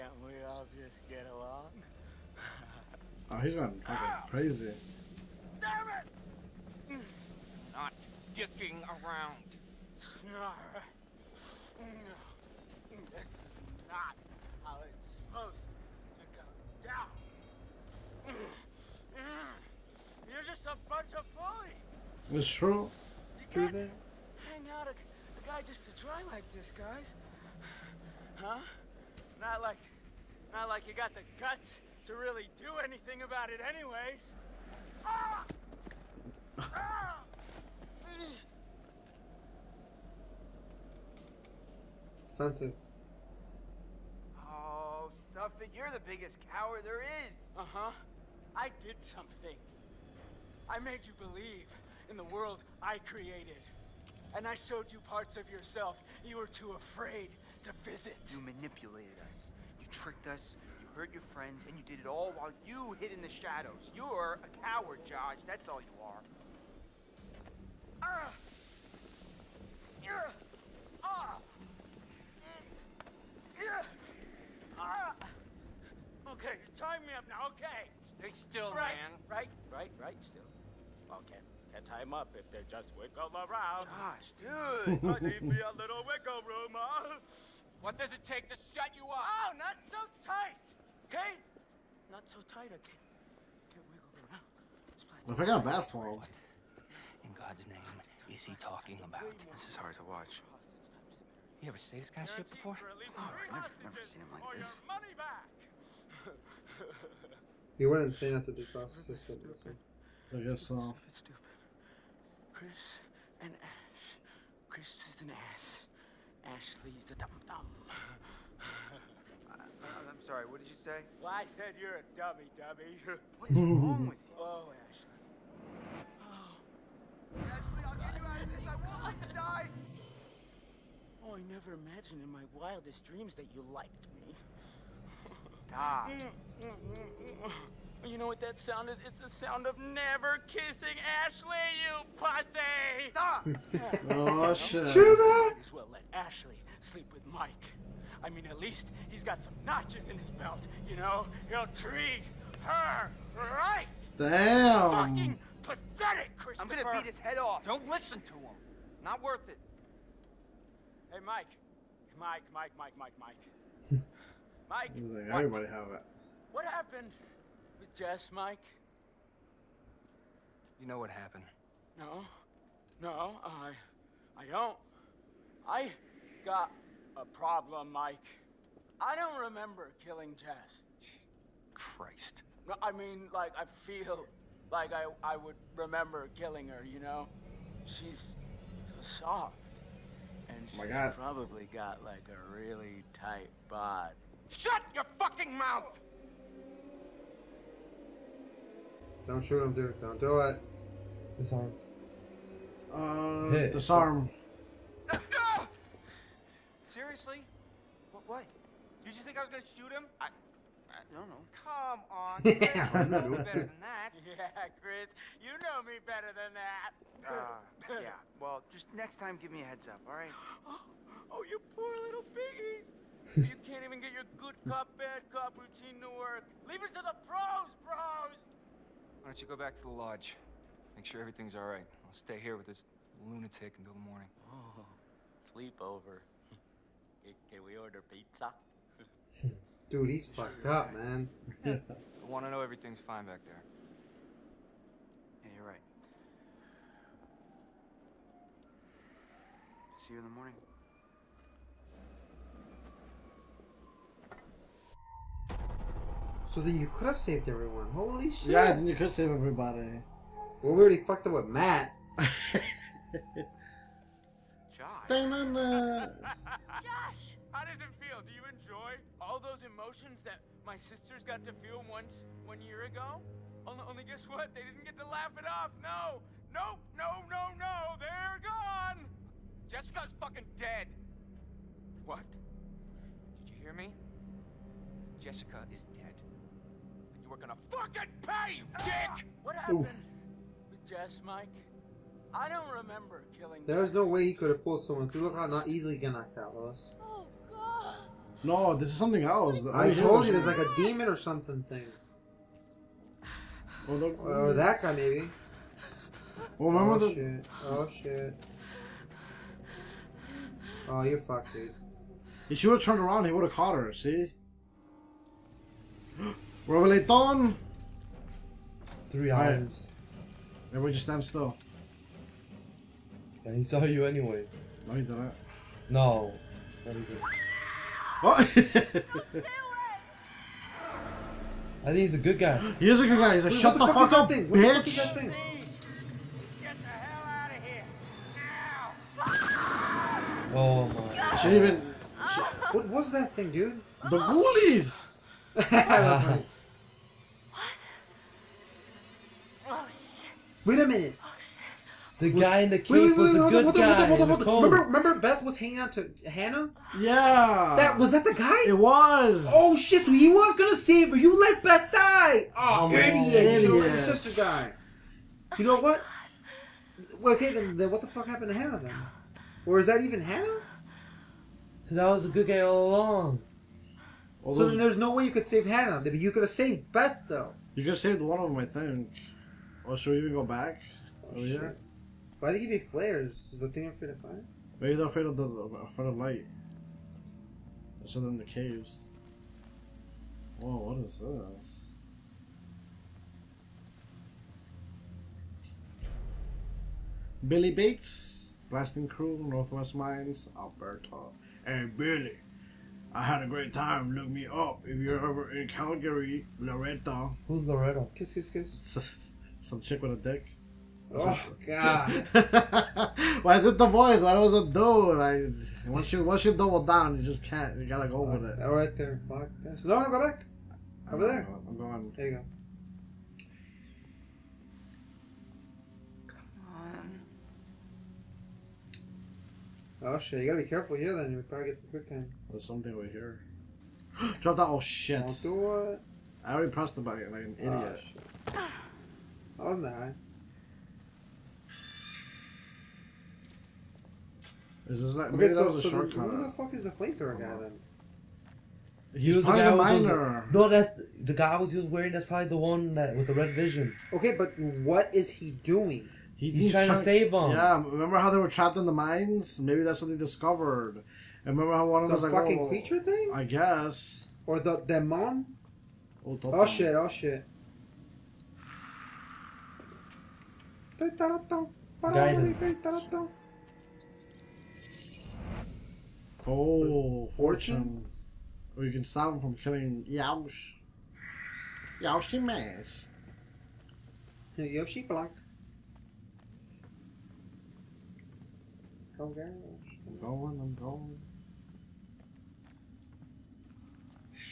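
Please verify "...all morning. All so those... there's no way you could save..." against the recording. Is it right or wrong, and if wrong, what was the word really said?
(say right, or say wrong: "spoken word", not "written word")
wrong: "along", not "morning".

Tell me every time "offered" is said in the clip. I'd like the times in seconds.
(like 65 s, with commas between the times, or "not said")
not said.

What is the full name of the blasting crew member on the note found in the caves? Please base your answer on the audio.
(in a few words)
Billy Bates.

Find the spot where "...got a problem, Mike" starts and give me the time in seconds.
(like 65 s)
176 s.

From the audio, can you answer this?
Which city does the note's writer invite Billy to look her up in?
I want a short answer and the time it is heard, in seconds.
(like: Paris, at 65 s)
Calgary, at 405 s.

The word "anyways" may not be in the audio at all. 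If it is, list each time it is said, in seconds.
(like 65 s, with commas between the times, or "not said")
33 s, 324 s.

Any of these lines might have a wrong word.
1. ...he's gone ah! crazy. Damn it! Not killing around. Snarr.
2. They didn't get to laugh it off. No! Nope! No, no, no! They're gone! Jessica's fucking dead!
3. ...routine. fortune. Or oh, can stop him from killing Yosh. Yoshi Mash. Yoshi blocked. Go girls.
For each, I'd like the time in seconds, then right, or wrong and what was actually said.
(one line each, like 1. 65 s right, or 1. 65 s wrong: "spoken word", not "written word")
1. 3 s wrong: "dicking", not "killing"
2. 274 s right
3. 477 s wrong: "fortune", not "routine".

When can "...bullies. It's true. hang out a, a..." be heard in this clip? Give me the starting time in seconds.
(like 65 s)
21 s.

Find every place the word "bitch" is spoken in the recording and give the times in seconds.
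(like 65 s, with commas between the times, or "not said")
334 s.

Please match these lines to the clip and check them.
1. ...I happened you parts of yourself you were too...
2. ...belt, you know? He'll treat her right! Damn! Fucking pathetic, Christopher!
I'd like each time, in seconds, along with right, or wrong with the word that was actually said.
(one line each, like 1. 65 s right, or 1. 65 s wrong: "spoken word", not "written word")
1. 54 s wrong: "showed", not "happened"
2. 150 s right.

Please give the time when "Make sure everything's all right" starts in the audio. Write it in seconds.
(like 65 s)
230 s.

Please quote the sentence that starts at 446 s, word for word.
Who the fuck is the flamethrower guy then?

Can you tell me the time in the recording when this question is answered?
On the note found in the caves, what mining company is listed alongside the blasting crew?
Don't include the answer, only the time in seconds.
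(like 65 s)
399 s.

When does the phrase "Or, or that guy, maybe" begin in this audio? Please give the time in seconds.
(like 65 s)
303 s.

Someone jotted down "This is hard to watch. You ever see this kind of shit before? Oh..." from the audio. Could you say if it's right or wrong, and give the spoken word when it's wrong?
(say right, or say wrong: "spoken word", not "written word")
right.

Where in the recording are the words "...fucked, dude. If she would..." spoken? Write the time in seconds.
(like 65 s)
311 s.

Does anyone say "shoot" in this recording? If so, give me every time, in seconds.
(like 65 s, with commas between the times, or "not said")
199 s, 209 s.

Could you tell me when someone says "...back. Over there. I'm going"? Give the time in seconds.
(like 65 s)
420 s.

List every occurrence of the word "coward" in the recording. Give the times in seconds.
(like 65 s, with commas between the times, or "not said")
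46 s, 64 s.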